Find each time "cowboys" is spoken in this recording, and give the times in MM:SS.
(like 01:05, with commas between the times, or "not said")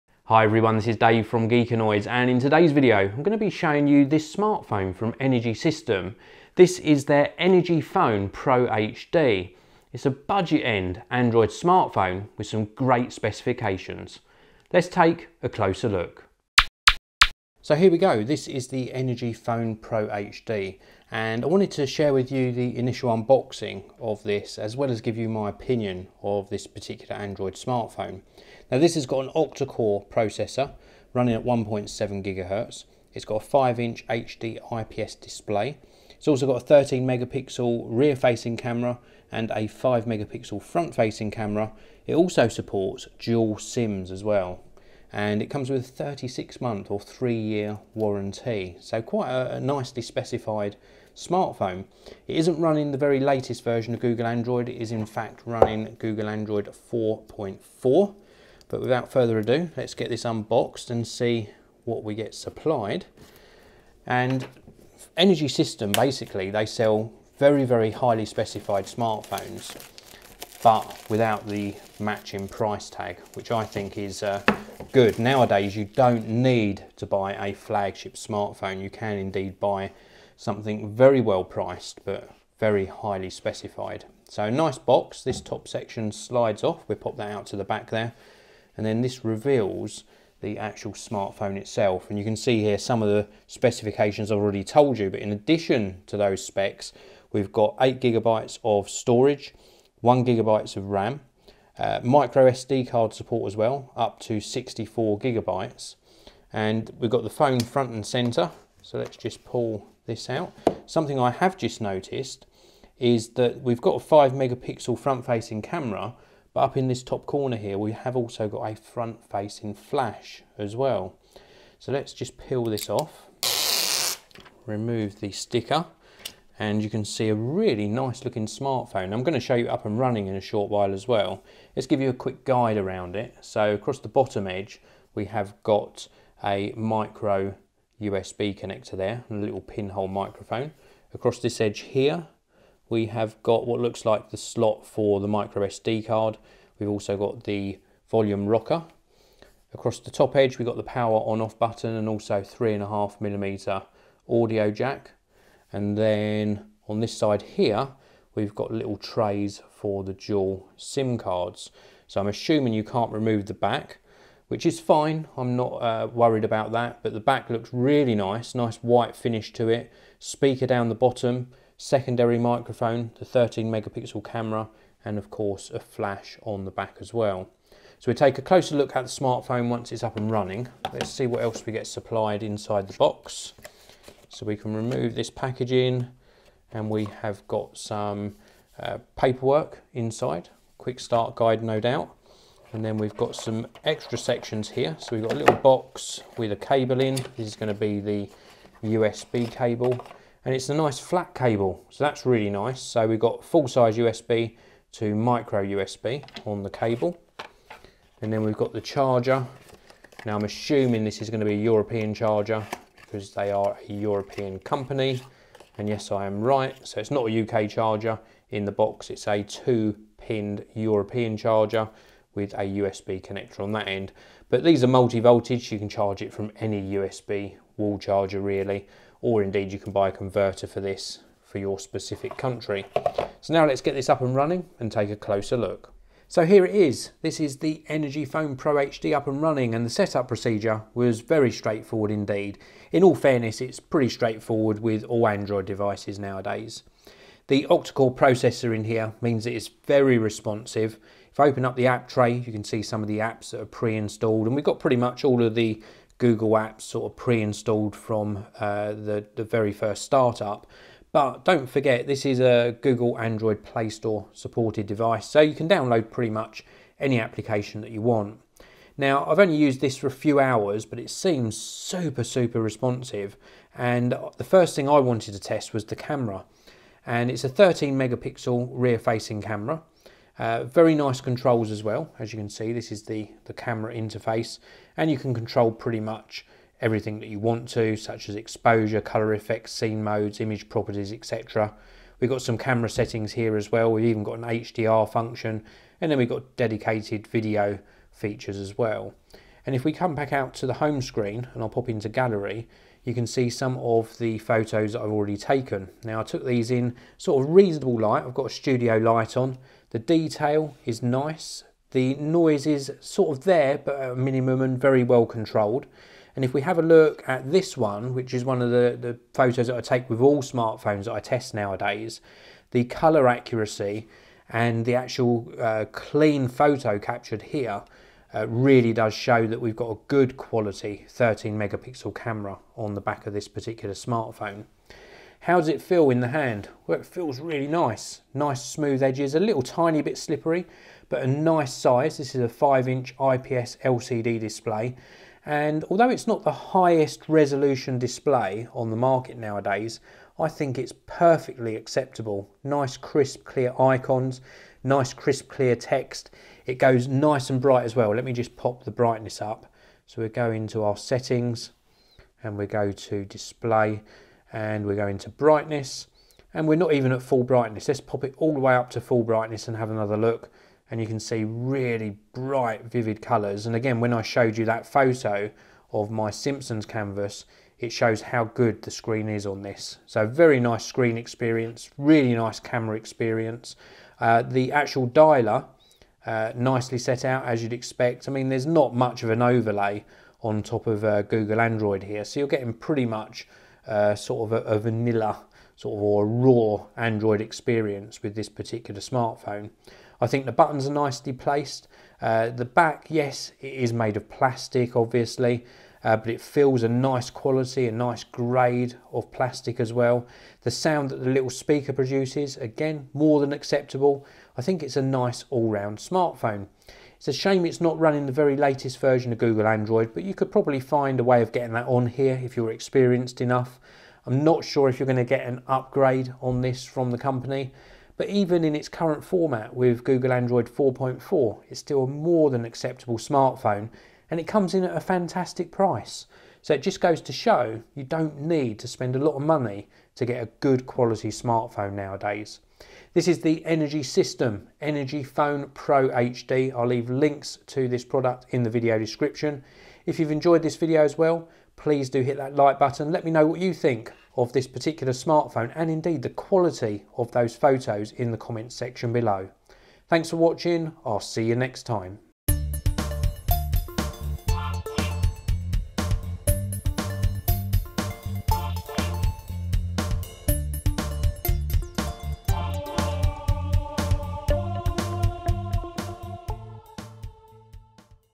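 not said.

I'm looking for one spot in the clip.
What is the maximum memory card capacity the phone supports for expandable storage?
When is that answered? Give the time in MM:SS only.
01:44.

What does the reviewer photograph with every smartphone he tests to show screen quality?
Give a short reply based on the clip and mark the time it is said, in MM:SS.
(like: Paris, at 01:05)
Simpsons canvas, at 06:16.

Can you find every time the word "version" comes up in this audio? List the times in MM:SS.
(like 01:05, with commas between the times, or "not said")
00:53, 06:58.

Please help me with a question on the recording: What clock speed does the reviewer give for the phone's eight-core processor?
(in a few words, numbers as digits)
1.7 GHz.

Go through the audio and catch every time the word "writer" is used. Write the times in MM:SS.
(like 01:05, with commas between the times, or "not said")
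not said.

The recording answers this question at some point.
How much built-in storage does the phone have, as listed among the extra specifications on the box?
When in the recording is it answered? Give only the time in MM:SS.
01:37.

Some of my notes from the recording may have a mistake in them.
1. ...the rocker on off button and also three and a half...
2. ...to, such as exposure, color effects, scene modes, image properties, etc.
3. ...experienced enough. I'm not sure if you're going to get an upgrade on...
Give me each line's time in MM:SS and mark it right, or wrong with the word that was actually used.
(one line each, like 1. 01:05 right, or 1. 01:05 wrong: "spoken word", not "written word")
1. 02:30 wrong: "power", not "rocker"
2. 04:47 right
3. 07:02 right.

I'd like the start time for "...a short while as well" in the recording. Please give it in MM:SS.
02:10.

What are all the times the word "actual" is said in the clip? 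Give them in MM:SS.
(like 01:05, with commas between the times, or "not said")
01:30, 05:24, 06:24.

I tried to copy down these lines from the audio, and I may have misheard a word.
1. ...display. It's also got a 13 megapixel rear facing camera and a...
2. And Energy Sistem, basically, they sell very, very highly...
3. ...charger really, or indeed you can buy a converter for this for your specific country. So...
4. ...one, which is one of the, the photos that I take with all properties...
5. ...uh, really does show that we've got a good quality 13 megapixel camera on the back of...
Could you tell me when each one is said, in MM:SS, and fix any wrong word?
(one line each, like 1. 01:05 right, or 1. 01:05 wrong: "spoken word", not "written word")
1. 00:35 right
2. 01:04 right
3. 03:47 right
4. 05:17 wrong: "smartphones", not "properties"
5. 05:28 right.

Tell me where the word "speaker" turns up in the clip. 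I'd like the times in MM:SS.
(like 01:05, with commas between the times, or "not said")
02:50, 06:51.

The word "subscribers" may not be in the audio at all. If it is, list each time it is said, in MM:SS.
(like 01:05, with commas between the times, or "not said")
not said.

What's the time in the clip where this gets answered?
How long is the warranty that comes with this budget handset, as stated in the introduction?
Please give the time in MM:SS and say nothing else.
00:45.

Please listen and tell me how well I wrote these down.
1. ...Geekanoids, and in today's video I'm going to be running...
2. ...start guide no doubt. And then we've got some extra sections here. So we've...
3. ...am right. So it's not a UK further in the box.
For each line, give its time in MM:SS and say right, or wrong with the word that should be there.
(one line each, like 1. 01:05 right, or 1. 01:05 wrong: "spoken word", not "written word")
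1. 00:01 wrong: "showing", not "running"
2. 03:11 right
3. 03:36 wrong: "charger", not "further".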